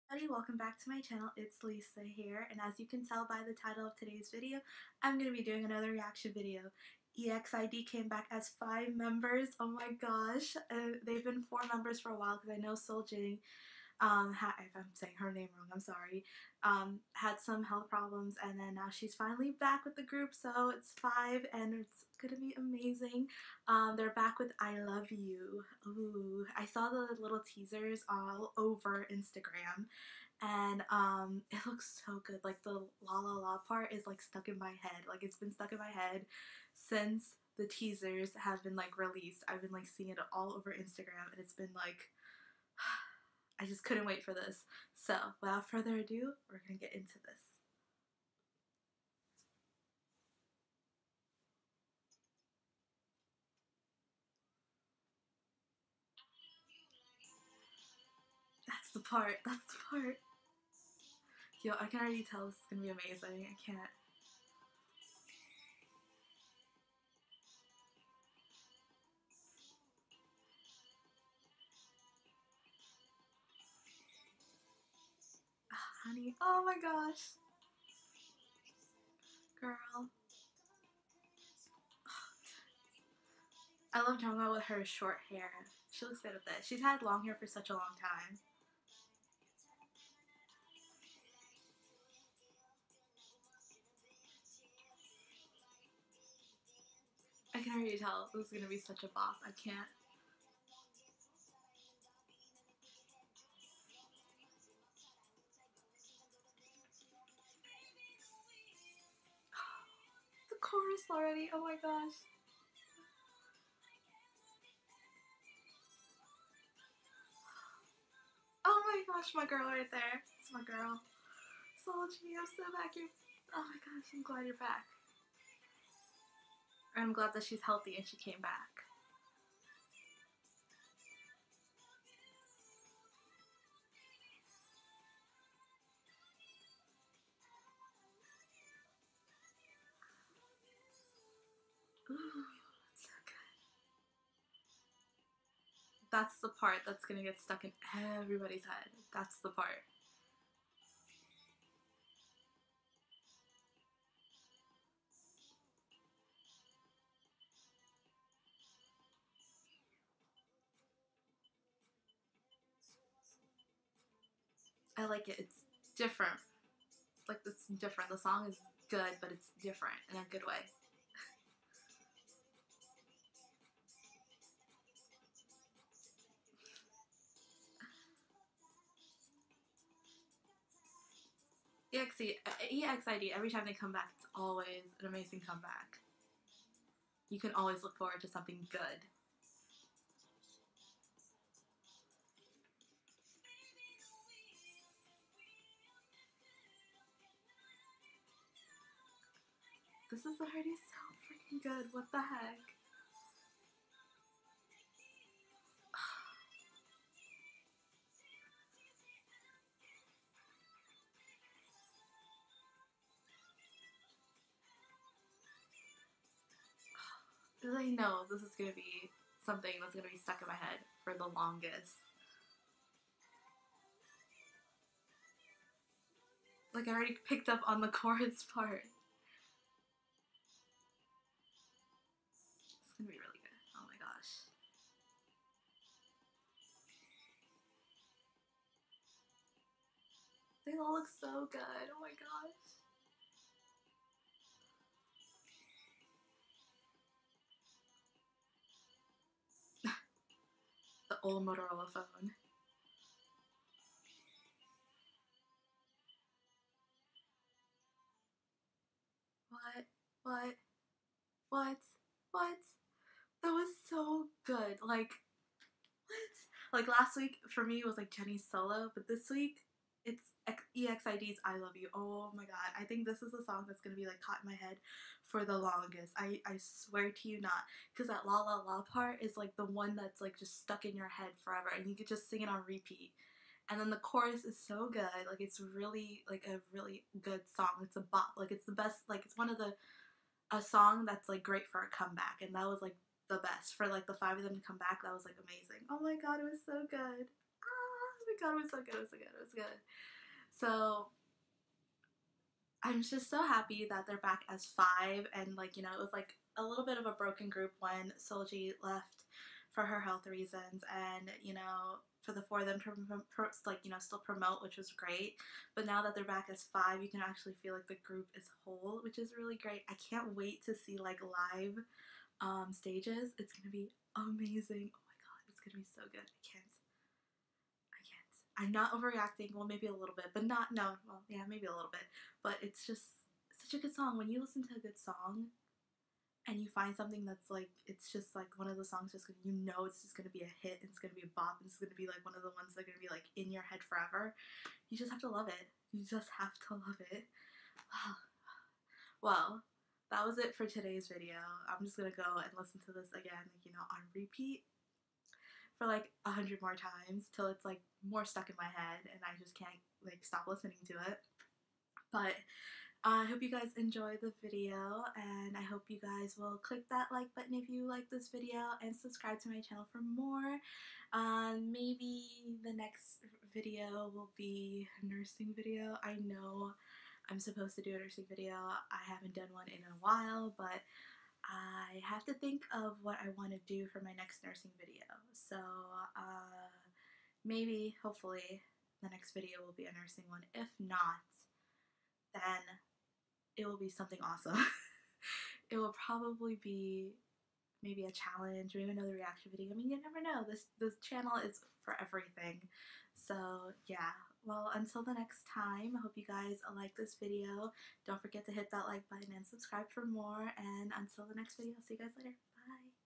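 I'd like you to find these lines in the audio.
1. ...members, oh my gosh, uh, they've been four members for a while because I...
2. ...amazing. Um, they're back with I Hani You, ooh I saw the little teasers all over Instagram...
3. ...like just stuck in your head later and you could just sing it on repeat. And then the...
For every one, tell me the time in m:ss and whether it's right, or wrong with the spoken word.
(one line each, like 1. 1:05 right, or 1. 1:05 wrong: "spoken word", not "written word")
1. 0:08 right
2. 0:22 wrong: "Love", not "Hani"
3. 4:40 wrong: "forever", not "later".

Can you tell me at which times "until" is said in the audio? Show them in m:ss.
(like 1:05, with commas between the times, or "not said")
6:44, 6:50.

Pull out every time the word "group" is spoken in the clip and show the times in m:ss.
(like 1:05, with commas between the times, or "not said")
0:20, 5:07, 5:18.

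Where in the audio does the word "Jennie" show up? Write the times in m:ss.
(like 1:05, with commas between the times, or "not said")
4:28.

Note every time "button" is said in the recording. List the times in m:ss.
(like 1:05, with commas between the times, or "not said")
6:07, 6:49.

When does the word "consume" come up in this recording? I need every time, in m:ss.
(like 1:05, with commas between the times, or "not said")
not said.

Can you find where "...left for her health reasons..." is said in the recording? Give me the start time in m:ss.
5:08.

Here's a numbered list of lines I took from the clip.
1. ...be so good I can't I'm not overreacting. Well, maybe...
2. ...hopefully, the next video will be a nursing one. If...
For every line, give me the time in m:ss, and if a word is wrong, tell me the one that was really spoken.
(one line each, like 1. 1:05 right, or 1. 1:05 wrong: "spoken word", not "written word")
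1. 5:25 right
2. 6:28 right.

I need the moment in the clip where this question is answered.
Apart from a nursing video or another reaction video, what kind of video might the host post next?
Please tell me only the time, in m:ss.
6:38.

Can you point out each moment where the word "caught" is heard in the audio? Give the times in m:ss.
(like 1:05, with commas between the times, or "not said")
4:34.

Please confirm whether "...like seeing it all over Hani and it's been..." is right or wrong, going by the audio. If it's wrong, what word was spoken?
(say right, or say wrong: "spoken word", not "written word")
wrong: "Instagram", not "Hani".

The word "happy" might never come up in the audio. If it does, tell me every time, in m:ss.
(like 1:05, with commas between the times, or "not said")
5:03.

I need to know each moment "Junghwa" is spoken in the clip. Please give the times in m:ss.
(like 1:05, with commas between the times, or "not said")
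1:24.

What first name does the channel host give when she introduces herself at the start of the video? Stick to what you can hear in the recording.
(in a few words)
Lisa.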